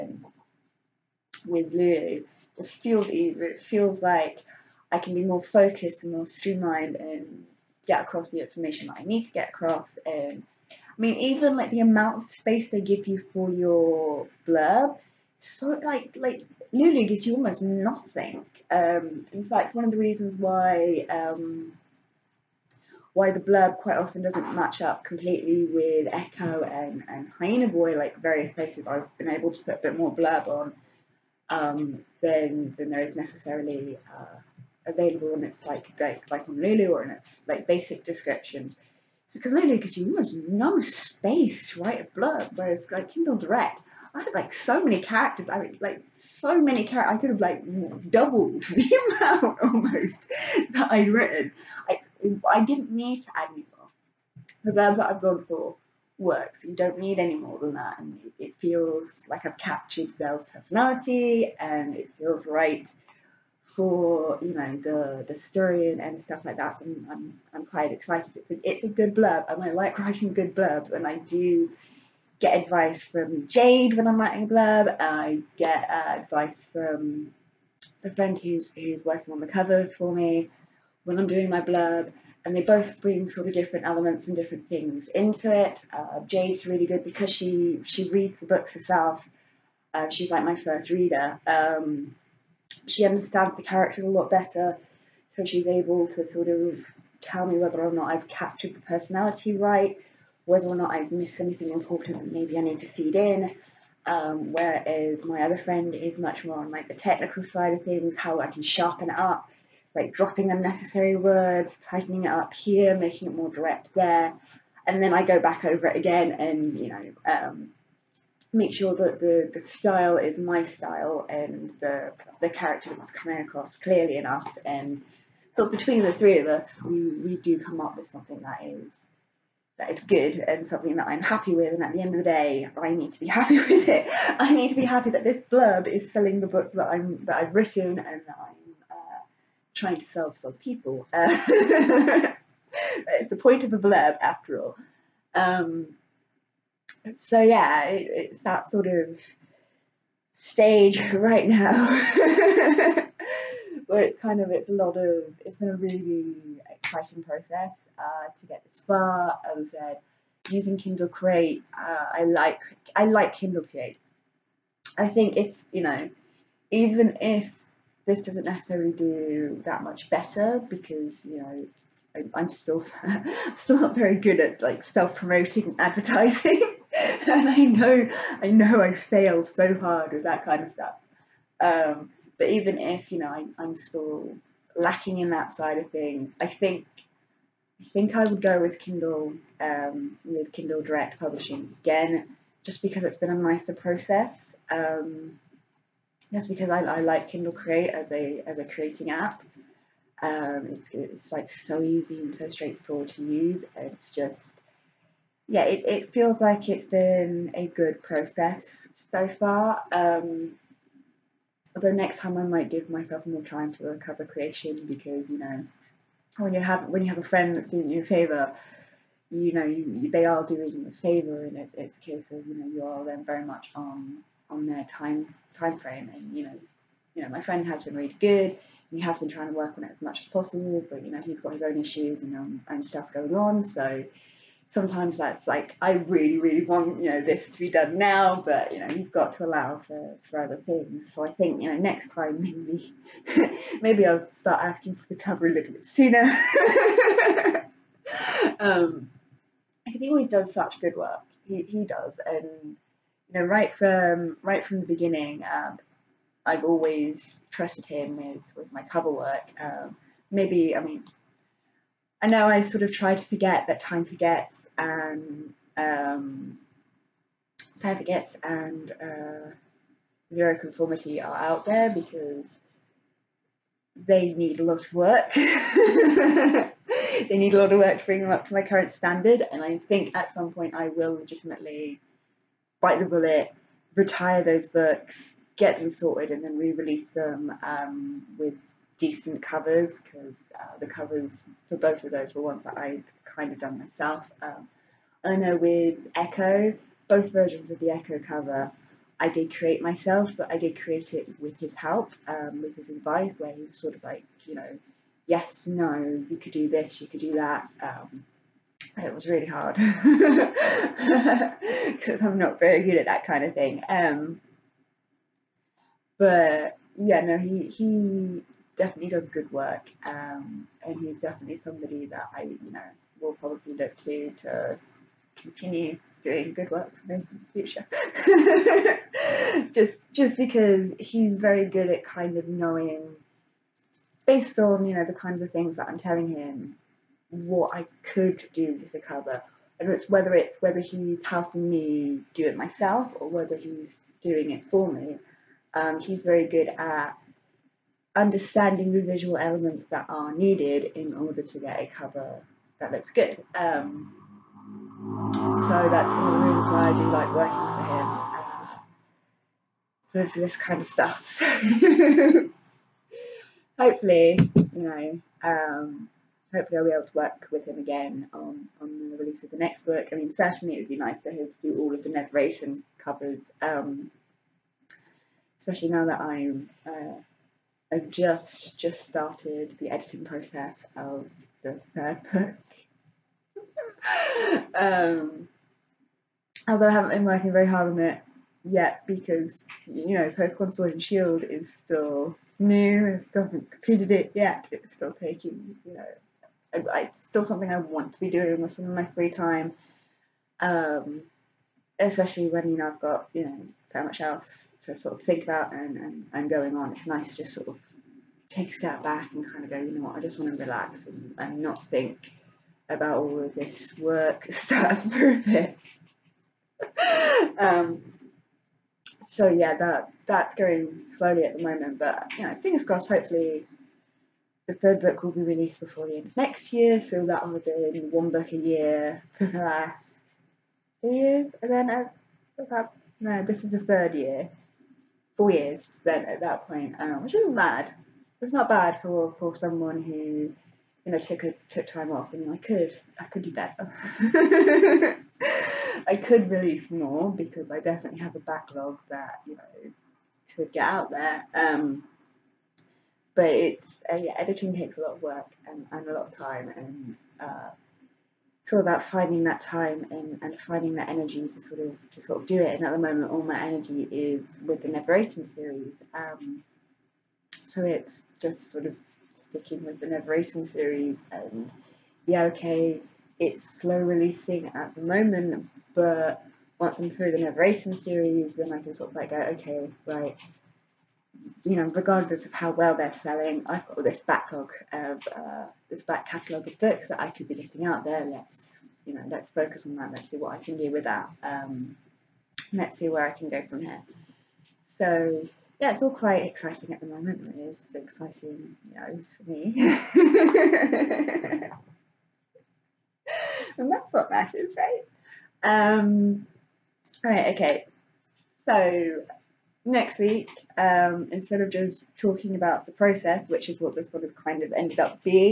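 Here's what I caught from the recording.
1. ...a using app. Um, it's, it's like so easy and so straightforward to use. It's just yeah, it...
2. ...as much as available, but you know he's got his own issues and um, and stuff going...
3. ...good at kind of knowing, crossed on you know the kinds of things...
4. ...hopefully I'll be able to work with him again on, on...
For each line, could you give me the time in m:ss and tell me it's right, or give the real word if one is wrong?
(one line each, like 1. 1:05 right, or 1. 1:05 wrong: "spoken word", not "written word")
1. 3:18 wrong: "creating", not "using"
2. 3:49 wrong: "possible", not "available"
3. 5:31 wrong: "based", not "crossed"
4. 6:06 right.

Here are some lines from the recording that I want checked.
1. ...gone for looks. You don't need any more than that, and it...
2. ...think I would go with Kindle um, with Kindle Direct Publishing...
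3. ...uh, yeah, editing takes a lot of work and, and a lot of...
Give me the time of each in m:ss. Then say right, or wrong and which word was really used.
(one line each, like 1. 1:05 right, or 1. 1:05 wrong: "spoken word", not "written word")
1. 0:55 wrong: "works", not "looks"
2. 3:07 right
3. 7:34 right.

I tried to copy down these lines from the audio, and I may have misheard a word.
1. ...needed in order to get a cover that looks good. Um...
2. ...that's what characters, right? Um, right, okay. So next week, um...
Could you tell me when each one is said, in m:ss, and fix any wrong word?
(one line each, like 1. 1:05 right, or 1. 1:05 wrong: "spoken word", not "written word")
1. 5:50 right
2. 8:23 wrong: "matters", not "characters".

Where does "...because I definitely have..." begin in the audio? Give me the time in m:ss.
7:27.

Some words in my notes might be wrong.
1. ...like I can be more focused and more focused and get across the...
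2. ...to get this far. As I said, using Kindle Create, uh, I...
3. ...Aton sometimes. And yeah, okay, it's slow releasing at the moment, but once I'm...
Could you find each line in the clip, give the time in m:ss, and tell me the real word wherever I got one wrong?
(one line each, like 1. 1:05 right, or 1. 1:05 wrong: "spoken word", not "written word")
1. 0:04 wrong: "streamlined", not "focused"
2. 2:38 right
3. 7:50 wrong: "series", not "sometimes".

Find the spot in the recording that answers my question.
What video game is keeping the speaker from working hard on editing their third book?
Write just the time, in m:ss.
6:30.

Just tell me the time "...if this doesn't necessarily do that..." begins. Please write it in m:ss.
2:47.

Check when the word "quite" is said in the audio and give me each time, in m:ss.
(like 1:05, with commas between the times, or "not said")
0:23, 1:07, 8:16.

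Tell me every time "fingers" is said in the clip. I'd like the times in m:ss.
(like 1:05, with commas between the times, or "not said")
7:02.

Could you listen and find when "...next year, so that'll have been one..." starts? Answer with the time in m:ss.
7:06.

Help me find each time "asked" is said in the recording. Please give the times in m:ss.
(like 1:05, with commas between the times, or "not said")
not said.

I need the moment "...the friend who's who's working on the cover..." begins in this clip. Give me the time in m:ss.
1:18.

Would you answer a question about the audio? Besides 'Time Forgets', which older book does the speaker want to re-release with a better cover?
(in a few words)
Zero Conformity.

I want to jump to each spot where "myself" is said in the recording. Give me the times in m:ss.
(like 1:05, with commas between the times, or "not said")
3:32, 4:53, 4:59, 5:42.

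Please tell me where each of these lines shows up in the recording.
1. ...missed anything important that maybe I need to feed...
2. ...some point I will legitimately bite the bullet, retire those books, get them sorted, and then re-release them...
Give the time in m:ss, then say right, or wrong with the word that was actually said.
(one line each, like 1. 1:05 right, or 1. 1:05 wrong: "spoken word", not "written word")
1. 1:41 right
2. 4:40 right.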